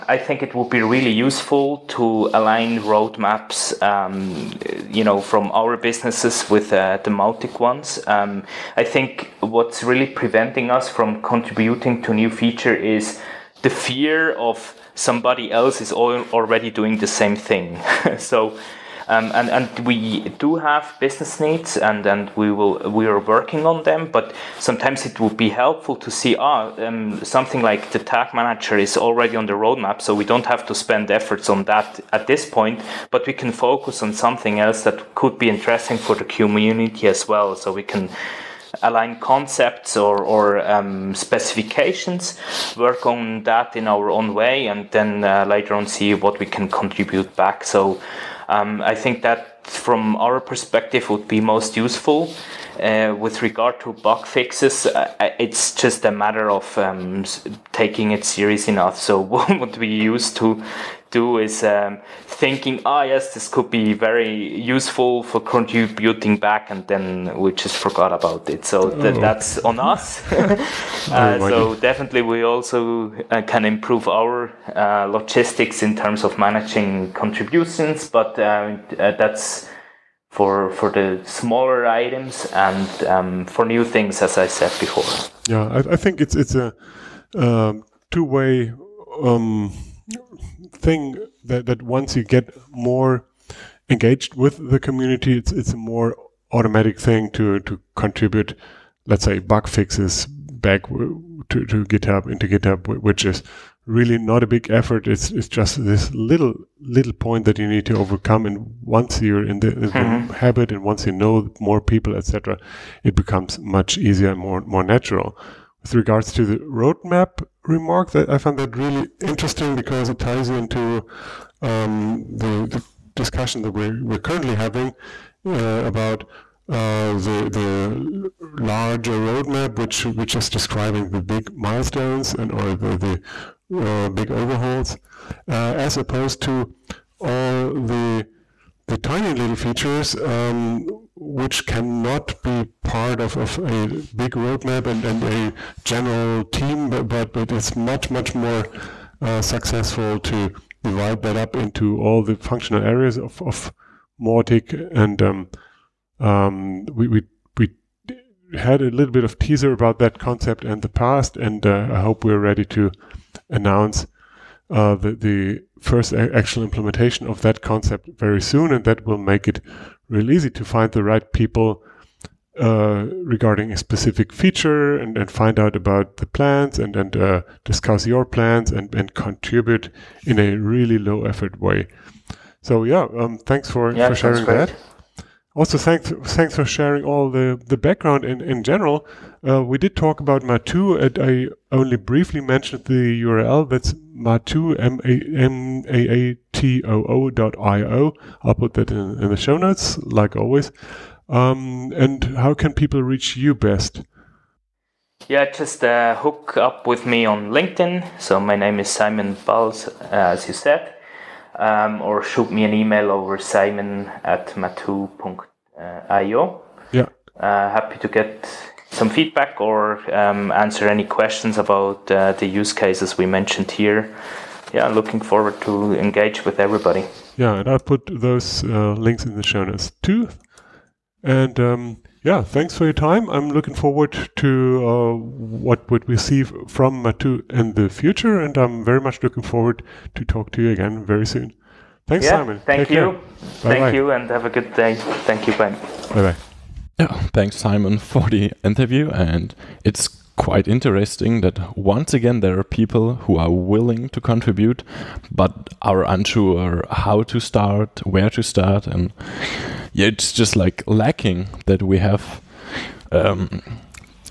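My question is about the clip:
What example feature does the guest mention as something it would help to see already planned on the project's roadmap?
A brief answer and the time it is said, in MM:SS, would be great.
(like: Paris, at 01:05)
tag manager, at 00:27.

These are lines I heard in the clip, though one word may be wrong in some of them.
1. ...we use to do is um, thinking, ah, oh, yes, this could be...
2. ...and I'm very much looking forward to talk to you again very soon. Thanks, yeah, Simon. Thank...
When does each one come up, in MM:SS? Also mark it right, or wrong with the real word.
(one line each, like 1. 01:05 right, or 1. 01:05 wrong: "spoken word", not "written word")
1. 00:59 right
2. 03:58 right.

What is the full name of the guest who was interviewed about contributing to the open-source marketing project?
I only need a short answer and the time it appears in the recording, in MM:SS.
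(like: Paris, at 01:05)
Simon Balz, at 03:28.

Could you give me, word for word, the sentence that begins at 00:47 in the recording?
So um, I think that from our perspective would be most useful.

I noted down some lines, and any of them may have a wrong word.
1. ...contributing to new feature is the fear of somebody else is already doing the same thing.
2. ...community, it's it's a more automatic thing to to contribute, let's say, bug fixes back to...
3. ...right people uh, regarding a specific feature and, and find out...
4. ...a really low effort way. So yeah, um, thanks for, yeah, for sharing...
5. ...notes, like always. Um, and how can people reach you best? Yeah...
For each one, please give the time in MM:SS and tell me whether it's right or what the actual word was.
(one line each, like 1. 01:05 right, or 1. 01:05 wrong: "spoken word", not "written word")
1. 00:11 right
2. 01:34 right
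3. 02:51 right
4. 03:00 right
5. 03:19 right.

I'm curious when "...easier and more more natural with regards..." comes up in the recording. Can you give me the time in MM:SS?
01:53.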